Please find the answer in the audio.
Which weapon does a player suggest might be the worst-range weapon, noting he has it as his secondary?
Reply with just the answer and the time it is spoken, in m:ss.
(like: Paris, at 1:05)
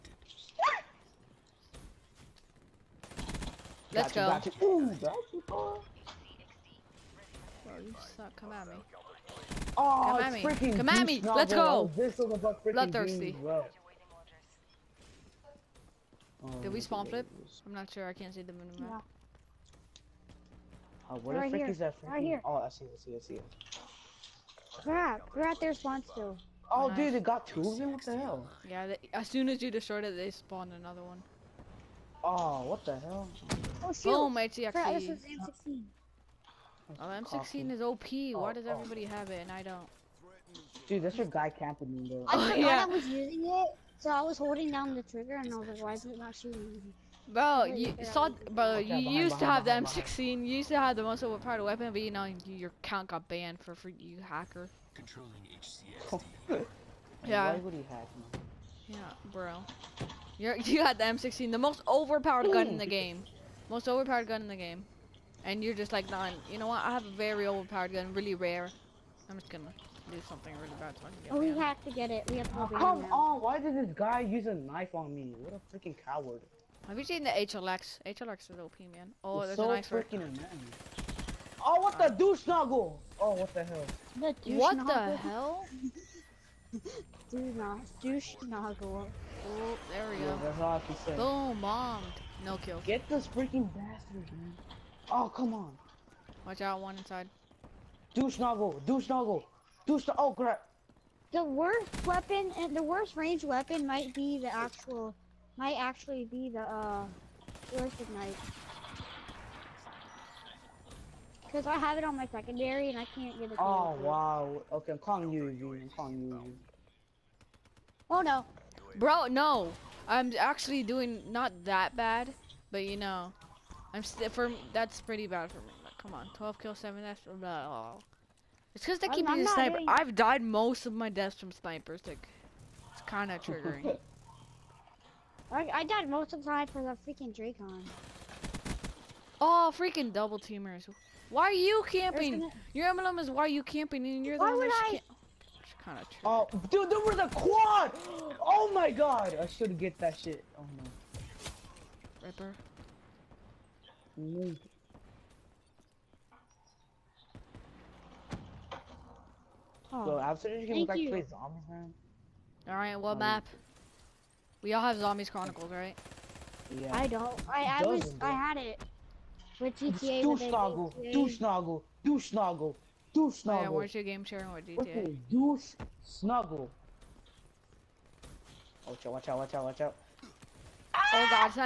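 ballistic knife, at 1:47.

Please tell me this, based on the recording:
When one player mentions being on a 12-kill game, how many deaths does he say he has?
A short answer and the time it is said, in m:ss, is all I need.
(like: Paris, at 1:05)
7, at 2:06.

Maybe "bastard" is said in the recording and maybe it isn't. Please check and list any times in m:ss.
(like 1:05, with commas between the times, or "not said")
1:33.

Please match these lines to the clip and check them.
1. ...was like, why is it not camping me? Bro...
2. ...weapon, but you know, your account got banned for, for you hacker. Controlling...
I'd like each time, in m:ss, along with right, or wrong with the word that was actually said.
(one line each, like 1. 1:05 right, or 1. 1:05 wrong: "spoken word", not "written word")
1. 0:45 wrong: "shooting", not "camping"
2. 0:51 right.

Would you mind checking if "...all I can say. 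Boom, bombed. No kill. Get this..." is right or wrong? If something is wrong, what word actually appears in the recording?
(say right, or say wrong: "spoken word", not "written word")
right.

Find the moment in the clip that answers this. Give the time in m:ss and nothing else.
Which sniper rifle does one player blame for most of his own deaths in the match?
2:17.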